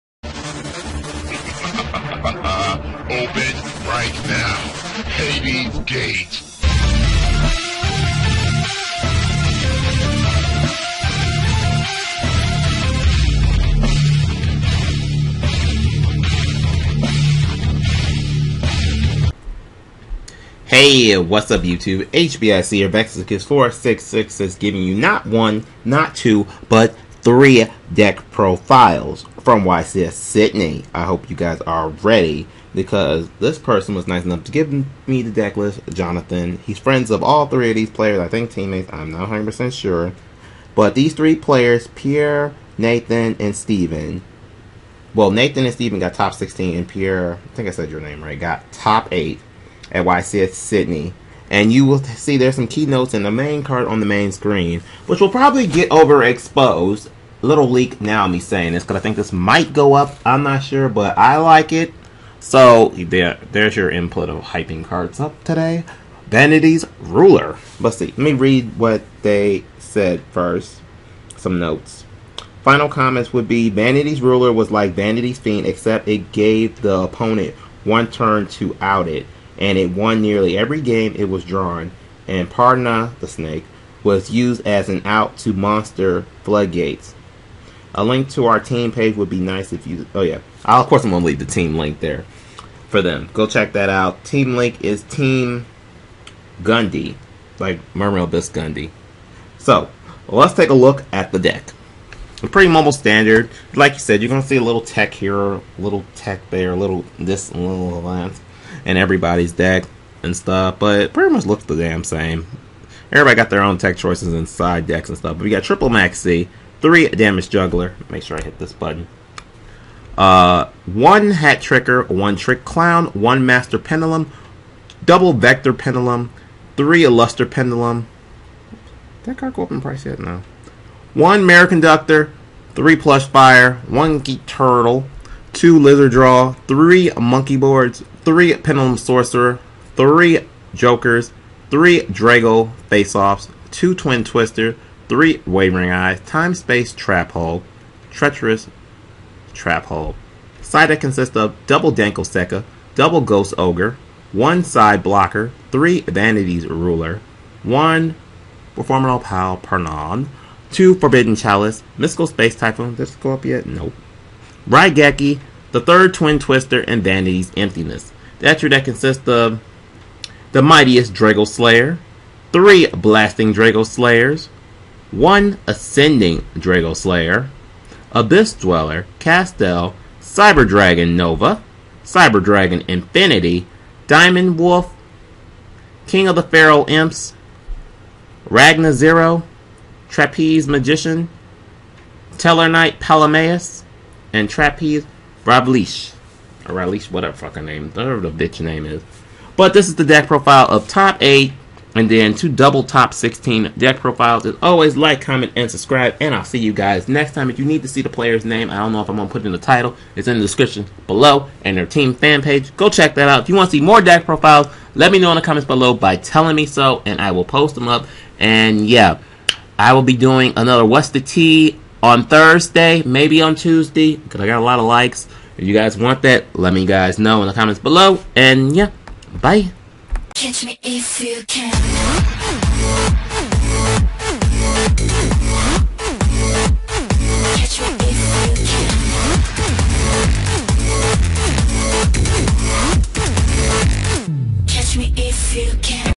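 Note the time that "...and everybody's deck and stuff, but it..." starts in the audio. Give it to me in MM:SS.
01:48.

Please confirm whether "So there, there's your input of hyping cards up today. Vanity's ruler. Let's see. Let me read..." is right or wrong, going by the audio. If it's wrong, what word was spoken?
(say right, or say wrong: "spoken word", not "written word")
right.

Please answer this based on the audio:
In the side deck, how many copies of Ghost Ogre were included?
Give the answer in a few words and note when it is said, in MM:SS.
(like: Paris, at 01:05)
2, at 02:32.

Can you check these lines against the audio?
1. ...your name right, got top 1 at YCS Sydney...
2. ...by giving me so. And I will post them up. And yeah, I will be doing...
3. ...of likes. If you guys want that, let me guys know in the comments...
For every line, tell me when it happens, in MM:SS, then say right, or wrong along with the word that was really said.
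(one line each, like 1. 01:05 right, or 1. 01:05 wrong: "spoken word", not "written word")
1. 00:47 wrong: "8", not "1"
2. 03:35 wrong: "telling", not "giving"
3. 03:44 right.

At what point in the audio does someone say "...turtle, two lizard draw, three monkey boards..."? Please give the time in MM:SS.
02:14.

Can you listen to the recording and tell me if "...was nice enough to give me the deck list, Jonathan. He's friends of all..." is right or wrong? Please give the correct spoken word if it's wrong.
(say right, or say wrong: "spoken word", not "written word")
right.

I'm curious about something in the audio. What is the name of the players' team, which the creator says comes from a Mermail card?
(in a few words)
Team Gundy.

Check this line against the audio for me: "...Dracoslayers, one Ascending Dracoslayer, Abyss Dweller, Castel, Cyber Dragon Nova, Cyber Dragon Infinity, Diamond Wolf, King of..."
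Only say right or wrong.
right.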